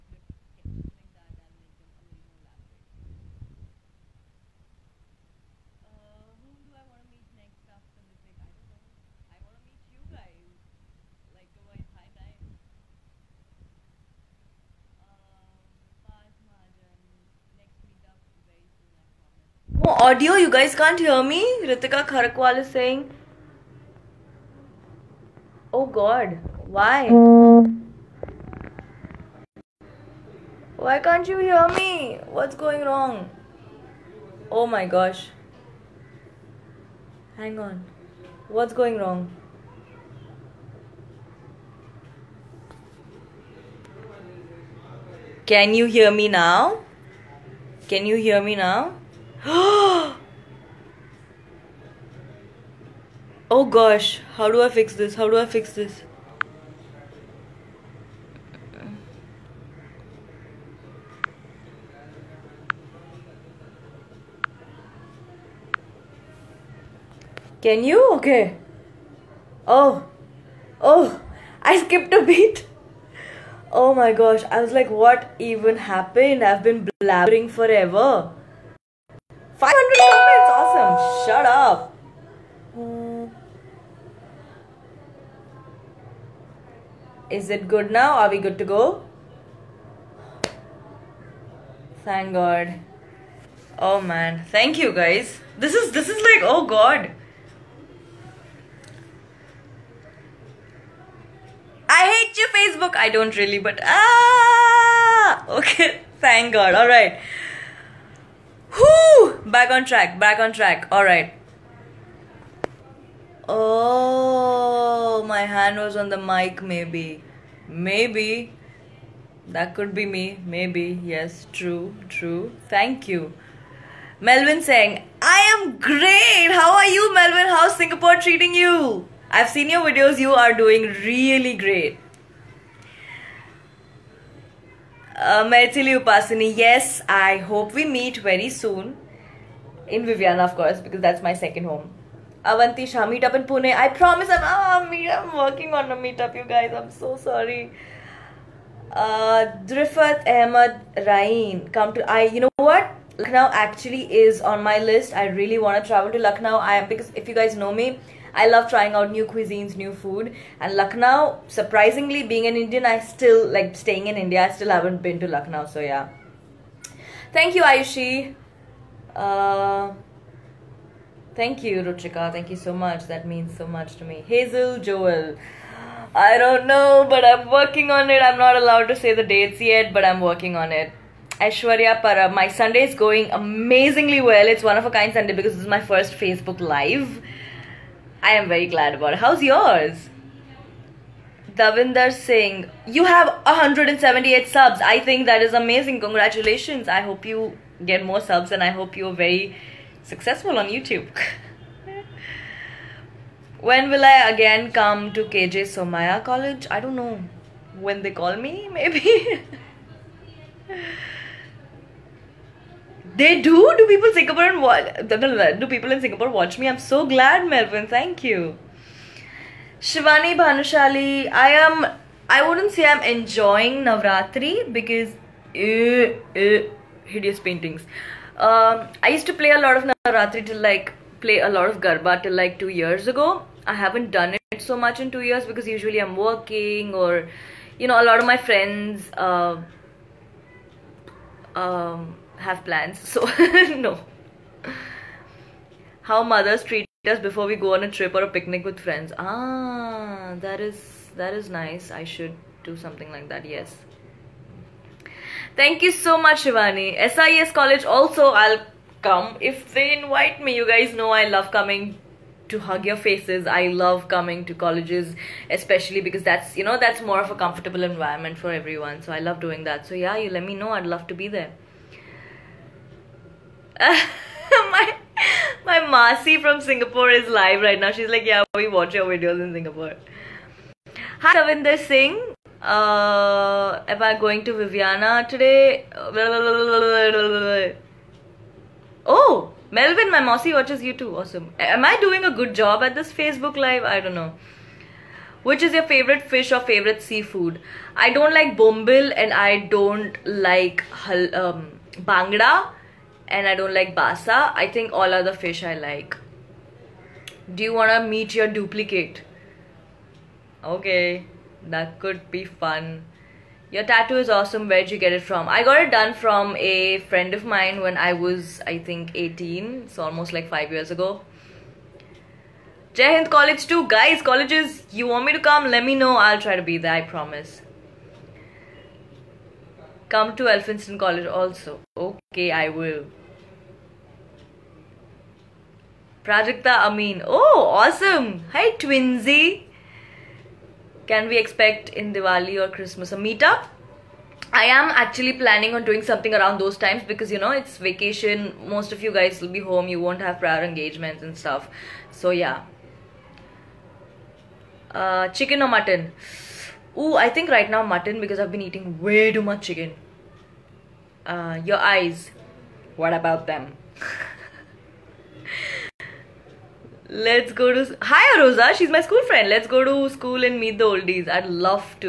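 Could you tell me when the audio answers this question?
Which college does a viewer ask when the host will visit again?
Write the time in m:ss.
3:25.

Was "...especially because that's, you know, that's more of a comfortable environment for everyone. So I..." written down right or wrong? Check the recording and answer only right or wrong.
right.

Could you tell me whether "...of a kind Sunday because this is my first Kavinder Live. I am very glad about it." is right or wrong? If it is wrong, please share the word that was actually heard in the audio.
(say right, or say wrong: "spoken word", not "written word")
wrong: "Facebook", not "Kavinder".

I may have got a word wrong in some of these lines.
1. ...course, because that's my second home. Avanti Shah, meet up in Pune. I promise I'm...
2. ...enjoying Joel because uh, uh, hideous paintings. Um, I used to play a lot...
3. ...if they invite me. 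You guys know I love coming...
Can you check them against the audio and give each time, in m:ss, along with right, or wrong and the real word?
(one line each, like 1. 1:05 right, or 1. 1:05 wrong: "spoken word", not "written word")
1. 2:20 right
2. 3:43 wrong: "Navratri", not "Joel"
3. 4:19 right.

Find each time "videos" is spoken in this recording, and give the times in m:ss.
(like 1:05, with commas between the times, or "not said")
2:09, 4:39.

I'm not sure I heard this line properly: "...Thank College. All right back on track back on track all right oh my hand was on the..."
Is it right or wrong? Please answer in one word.
wrong.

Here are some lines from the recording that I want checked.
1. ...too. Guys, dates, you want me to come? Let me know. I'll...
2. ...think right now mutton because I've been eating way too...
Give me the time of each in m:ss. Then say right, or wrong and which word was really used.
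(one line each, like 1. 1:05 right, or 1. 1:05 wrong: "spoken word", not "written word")
1. 5:23 wrong: "colleges", not "dates"
2. 5:57 right.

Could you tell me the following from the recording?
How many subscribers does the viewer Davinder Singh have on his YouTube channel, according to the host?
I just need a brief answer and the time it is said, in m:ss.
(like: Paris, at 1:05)
178, at 3:13.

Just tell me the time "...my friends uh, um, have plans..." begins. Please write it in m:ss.
3:58.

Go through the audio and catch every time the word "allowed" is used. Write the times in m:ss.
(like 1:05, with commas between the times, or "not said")
2:58.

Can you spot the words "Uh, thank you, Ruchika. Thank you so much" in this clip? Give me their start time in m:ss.
2:49.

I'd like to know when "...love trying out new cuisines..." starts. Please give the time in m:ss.
2:38.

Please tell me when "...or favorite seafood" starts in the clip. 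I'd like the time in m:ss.
4:56.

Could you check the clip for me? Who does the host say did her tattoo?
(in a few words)
From a friend.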